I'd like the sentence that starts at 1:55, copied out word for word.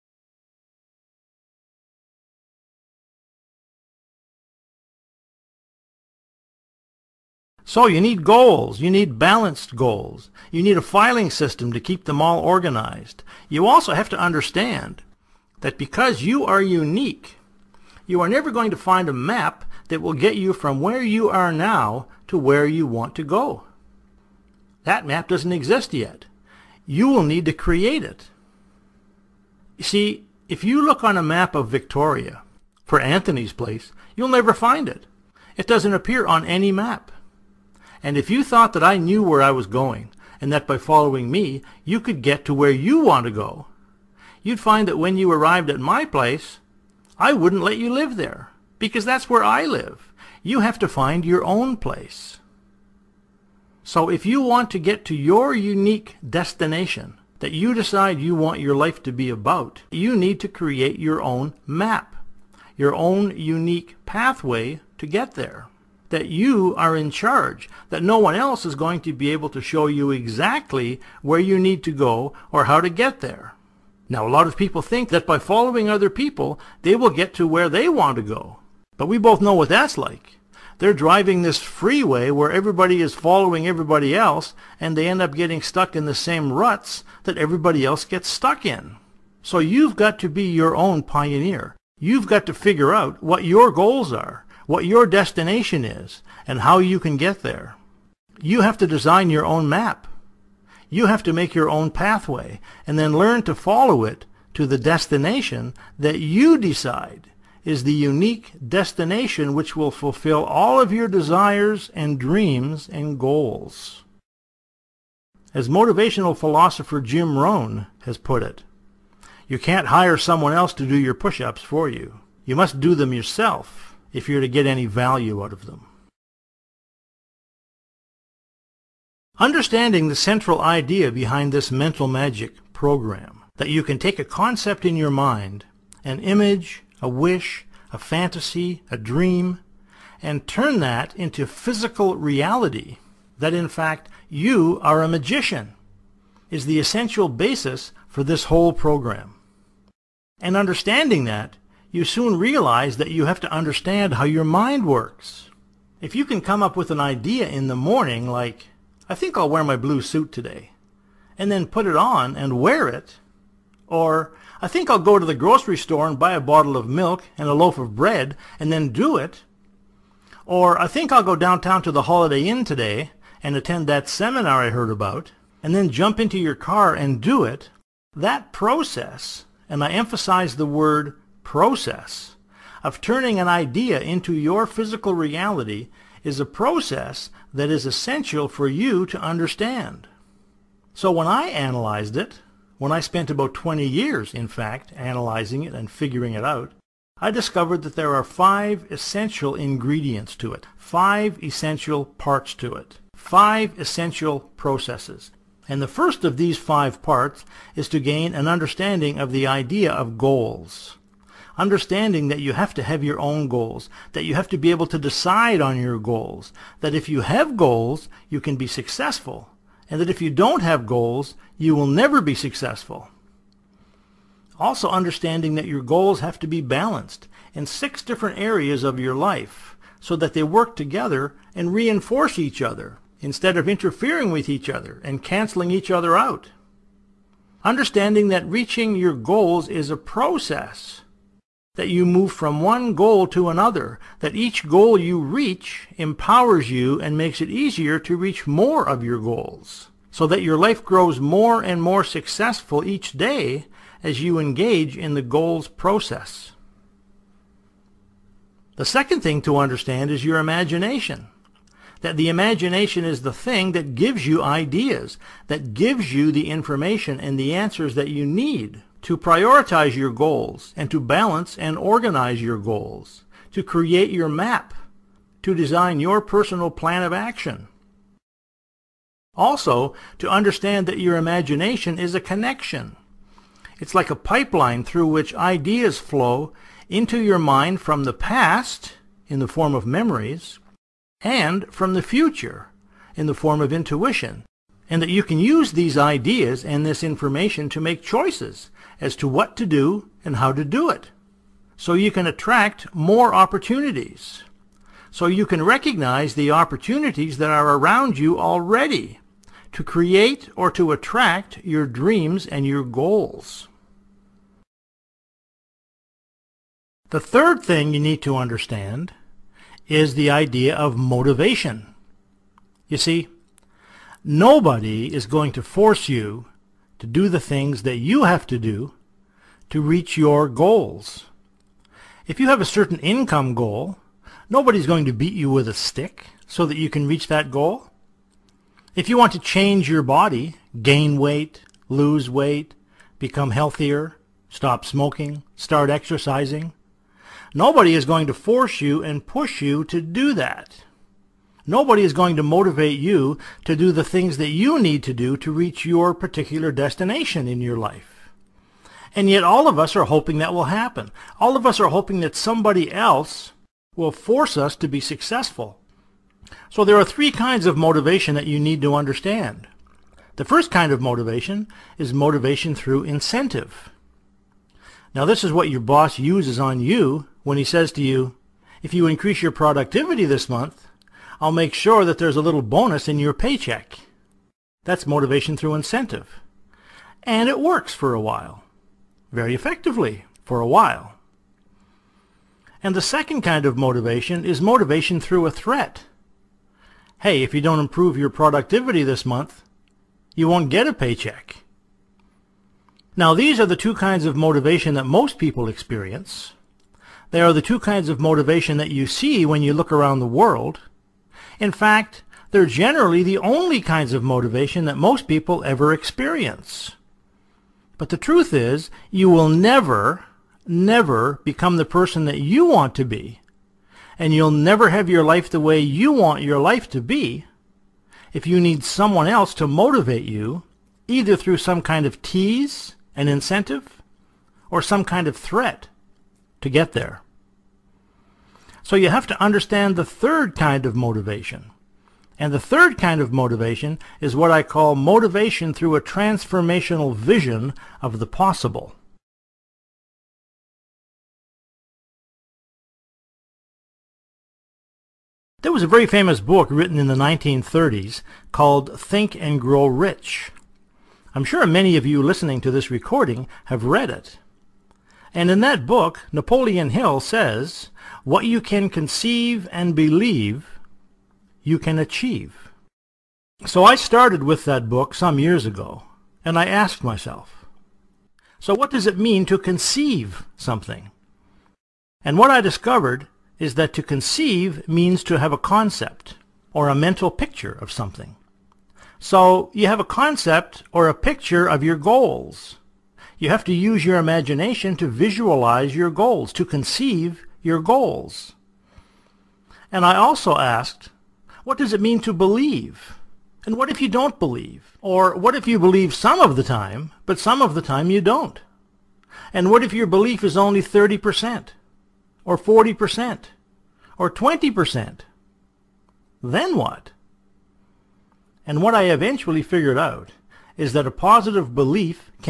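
As motivational philosopher Jim Rohn has put it, you can't hire someone else to do your push-ups for you.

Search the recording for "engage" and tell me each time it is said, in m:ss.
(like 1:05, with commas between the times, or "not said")
4:14.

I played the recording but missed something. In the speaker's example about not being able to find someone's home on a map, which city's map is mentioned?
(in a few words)
Victoria.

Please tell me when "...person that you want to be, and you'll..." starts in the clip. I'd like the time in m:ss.
7:01.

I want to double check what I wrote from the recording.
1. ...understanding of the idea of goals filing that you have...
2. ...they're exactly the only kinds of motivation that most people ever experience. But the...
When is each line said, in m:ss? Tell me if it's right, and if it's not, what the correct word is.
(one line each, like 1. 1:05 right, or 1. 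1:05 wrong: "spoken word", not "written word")
1. 3:28 wrong: "understanding", not "filing"
2. 6:52 wrong: "generally", not "exactly".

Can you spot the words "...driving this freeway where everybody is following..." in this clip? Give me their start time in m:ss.
1:20.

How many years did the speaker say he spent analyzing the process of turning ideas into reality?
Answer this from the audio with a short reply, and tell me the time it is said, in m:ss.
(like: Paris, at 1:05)
20, at 3:13.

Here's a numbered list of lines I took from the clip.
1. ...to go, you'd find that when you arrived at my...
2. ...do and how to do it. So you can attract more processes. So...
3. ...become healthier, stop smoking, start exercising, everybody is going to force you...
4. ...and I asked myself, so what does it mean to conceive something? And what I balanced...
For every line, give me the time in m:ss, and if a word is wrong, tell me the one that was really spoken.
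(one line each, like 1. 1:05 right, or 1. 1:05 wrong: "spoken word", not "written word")
1. 0:43 right
2. 4:59 wrong: "opportunities", not "processes"
3. 5:43 wrong: "nobody", not "everybody"
4. 7:56 wrong: "discovered", not "balanced".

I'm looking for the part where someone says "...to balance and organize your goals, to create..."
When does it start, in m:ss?
4:30.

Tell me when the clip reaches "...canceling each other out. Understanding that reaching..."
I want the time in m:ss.
3:55.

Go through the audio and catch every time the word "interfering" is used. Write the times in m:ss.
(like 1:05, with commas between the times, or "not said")
3:53.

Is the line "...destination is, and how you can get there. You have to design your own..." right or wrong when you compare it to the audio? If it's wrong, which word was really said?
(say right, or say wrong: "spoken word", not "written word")
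right.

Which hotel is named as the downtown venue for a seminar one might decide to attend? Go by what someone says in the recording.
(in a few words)
Holiday Inn.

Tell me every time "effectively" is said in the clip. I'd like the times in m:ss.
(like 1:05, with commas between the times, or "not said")
6:29.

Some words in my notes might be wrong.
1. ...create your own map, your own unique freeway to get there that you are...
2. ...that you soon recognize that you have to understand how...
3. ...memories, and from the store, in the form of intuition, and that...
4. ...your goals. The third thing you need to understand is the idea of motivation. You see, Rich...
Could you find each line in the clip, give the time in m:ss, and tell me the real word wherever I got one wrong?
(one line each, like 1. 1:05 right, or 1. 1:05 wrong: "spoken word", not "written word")
1. 1:00 wrong: "pathway", not "freeway"
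2. 2:31 wrong: "realize", not "recognize"
3. 4:49 wrong: "future", not "store"
4. 5:12 wrong: "Nobody", not "Rich".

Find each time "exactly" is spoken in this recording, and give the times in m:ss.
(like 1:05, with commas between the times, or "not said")
1:10.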